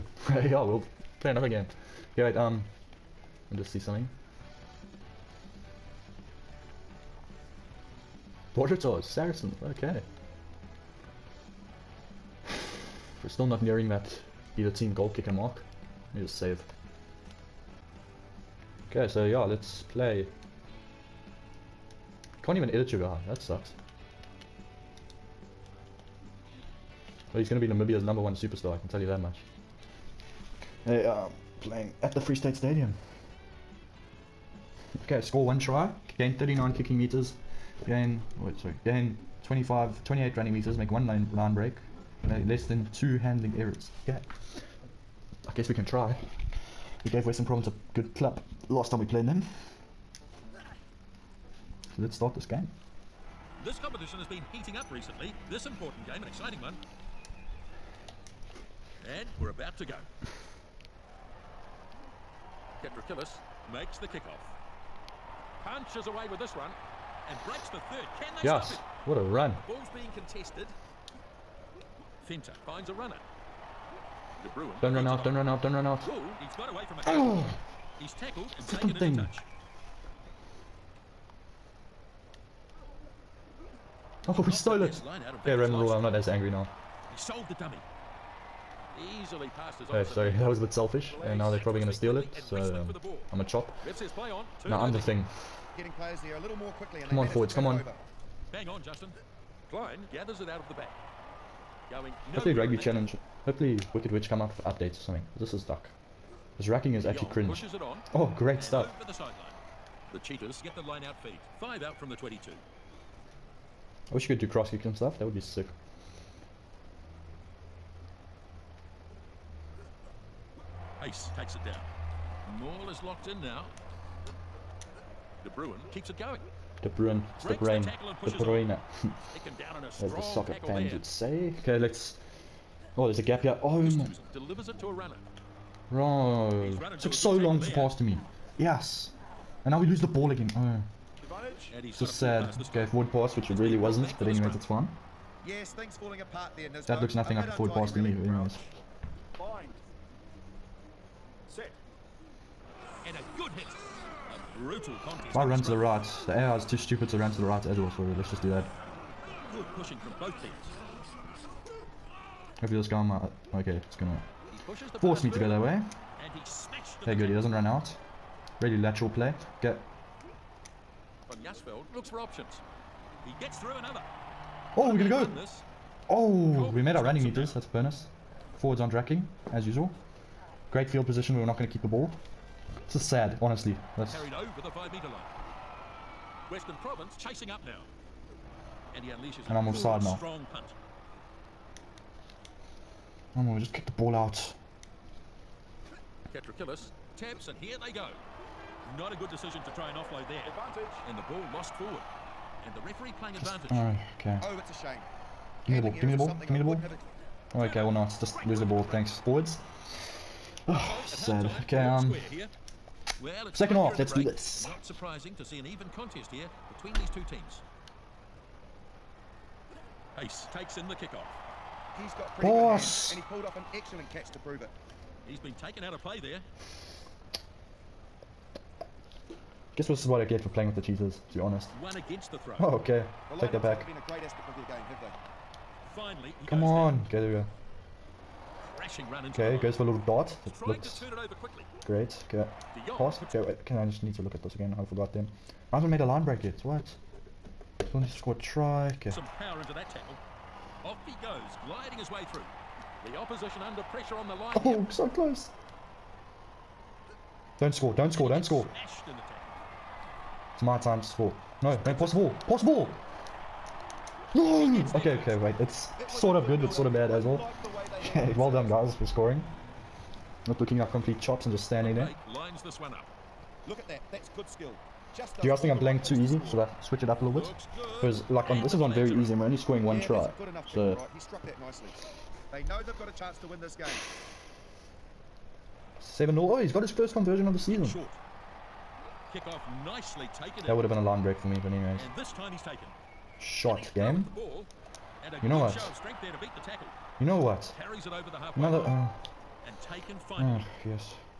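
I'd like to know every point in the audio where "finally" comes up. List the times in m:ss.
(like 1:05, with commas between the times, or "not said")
3:55, 5:00.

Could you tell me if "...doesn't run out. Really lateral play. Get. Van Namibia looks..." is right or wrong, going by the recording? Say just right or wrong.
wrong.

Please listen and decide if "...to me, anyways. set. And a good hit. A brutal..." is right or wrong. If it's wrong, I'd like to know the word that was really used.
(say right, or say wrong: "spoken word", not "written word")
right.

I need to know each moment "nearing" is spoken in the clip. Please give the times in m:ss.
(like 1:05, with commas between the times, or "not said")
0:13.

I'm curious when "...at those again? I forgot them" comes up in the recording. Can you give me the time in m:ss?
4:04.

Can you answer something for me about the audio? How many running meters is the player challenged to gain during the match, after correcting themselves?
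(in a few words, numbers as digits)
28.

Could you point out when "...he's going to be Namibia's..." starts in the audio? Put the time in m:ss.
0:27.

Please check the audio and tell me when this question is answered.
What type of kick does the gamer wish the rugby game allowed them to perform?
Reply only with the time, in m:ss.
1:54.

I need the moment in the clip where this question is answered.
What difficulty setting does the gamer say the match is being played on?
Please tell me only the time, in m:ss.
4:38.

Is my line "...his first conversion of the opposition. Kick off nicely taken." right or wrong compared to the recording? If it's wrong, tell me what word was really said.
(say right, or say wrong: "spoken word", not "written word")
wrong: "season", not "opposition".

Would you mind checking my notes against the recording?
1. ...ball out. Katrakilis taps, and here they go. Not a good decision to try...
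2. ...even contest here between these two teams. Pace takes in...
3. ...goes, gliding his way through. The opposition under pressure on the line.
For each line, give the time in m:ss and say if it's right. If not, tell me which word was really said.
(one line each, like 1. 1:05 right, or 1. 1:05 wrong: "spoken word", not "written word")
1. 3:13 right
2. 3:35 right
3. 4:11 right.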